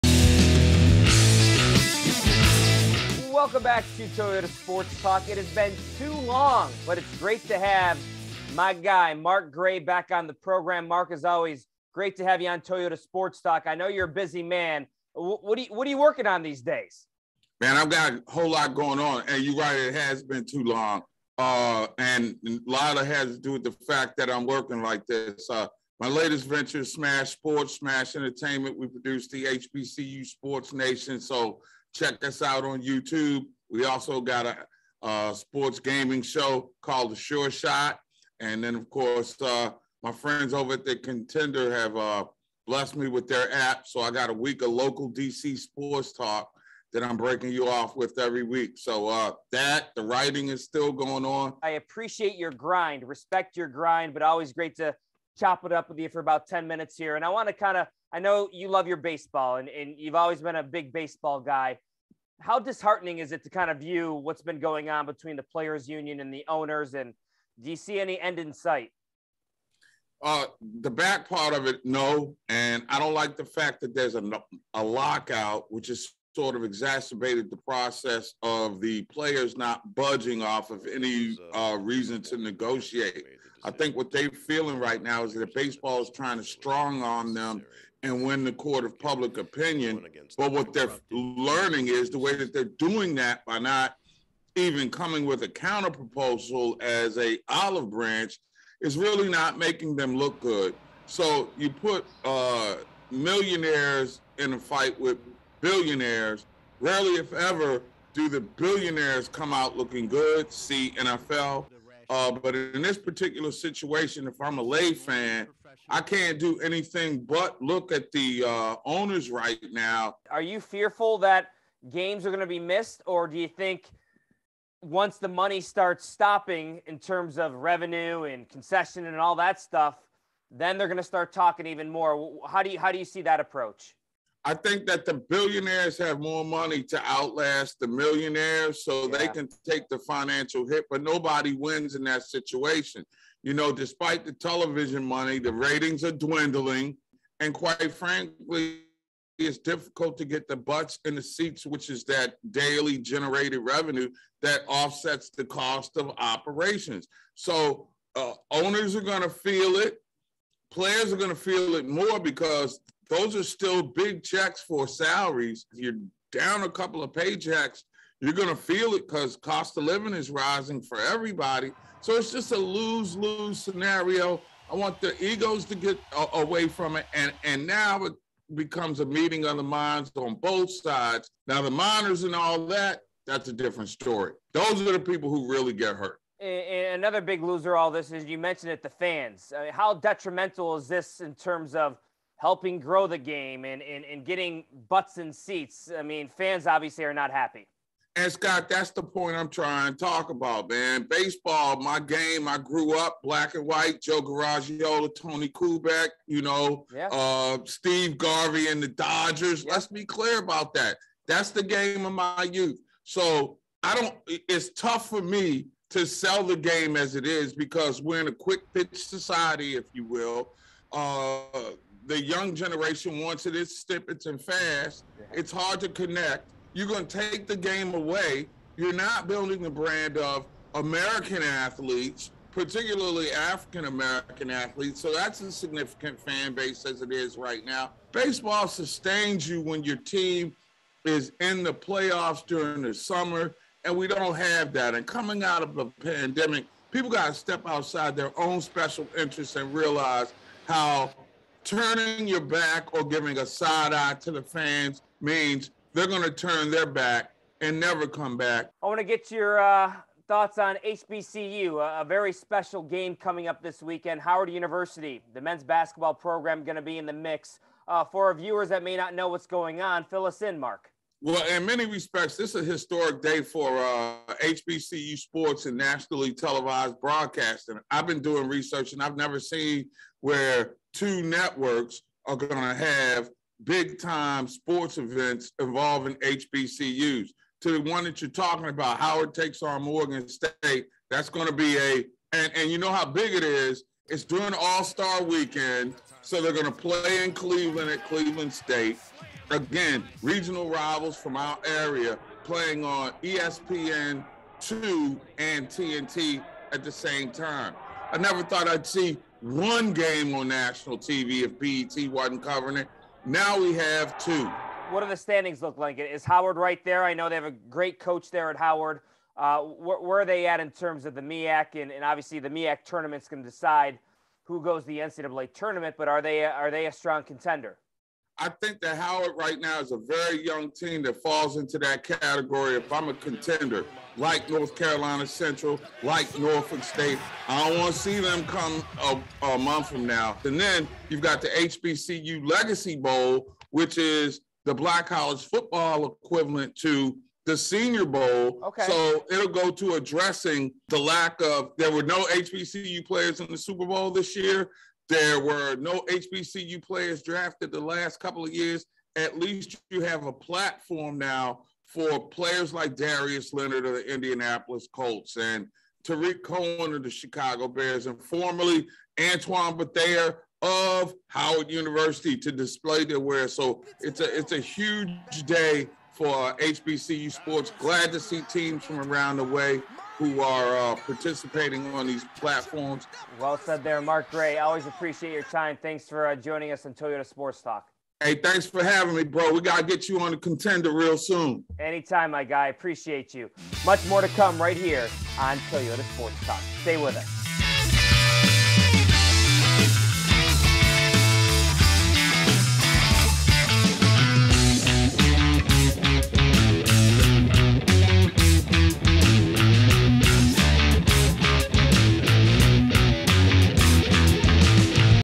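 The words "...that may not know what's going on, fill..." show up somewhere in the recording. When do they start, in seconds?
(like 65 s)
268 s.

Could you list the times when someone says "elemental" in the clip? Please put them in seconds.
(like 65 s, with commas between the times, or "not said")
not said.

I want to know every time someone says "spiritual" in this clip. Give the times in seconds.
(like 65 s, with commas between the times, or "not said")
not said.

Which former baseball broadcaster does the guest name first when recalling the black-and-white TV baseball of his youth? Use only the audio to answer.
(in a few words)
Joe Garagiola.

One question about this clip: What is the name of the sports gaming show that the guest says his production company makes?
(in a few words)
The Sure Shot.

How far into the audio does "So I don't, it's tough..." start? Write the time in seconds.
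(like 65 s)
213 s.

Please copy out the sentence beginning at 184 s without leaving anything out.
Those are the people who really get hurt.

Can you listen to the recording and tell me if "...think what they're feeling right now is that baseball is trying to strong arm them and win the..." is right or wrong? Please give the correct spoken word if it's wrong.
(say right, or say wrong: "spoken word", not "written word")
right.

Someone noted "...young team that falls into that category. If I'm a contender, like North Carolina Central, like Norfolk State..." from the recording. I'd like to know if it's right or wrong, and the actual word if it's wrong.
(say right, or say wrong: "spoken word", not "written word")
right.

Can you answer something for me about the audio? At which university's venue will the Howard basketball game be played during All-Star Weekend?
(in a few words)
Cleveland State.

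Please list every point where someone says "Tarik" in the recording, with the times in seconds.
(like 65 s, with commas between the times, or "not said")
366 s.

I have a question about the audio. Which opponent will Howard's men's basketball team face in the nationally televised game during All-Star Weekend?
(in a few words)
Morgan State.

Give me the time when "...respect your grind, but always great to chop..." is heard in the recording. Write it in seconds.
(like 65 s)
53 s.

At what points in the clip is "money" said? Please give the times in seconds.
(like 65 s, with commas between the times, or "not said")
125 s, 136 s, 145 s.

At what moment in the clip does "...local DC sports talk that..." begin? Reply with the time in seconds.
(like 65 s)
44 s.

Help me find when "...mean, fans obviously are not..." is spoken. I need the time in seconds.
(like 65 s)
196 s.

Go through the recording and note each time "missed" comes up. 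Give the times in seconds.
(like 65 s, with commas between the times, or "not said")
122 s.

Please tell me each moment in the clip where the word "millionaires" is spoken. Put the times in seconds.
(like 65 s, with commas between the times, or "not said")
103 s, 137 s.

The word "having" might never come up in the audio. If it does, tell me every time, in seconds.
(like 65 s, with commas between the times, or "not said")
388 s.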